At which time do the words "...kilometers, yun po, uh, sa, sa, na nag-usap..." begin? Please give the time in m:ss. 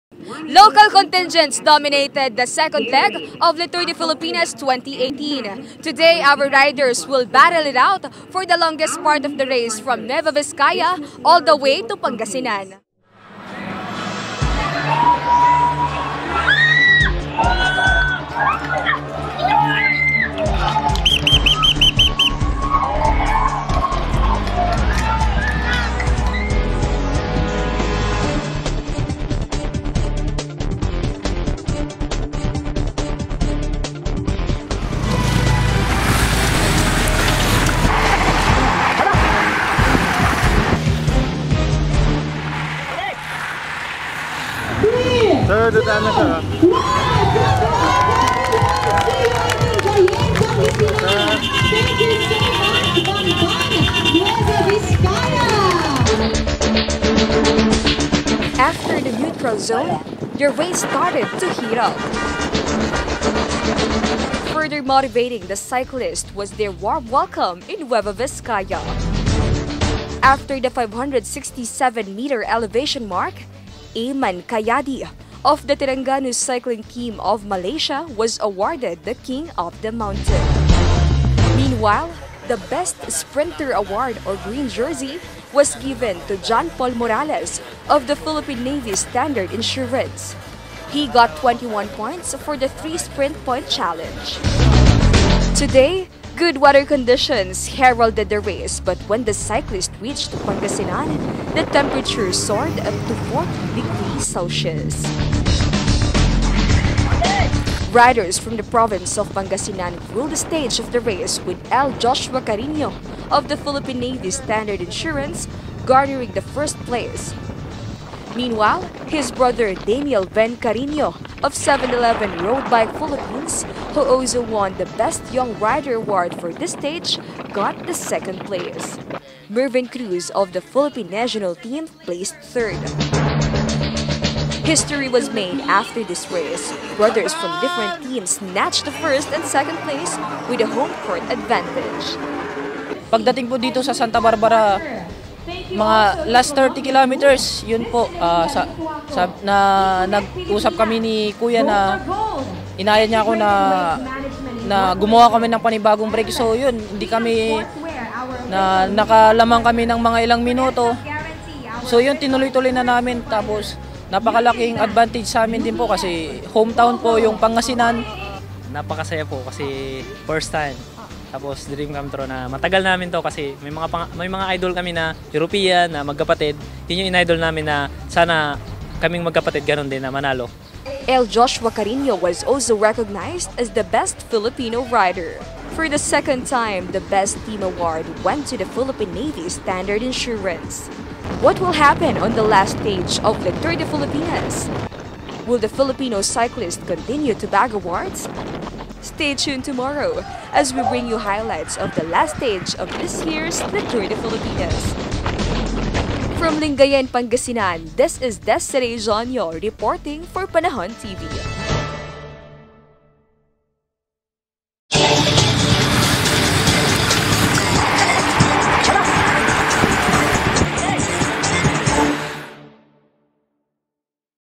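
2:26.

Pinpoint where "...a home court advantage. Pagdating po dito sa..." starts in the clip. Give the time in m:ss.
2:20.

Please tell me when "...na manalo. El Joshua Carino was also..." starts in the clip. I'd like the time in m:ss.
3:00.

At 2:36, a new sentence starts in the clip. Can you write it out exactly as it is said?
So yun, hindi kami na nakalamang kami ng mga ilang minuto.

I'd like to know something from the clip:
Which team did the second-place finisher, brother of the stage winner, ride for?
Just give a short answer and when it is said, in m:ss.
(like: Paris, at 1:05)
7-Eleven Road Bike Philippines, at 2:01.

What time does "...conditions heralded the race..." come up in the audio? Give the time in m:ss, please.
1:36.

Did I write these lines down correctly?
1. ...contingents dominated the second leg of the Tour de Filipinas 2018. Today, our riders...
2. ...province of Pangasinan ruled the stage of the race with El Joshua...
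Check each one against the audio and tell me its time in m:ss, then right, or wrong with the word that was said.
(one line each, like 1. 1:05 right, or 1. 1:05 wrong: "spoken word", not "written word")
1. 0:00 right
2. 1:48 right.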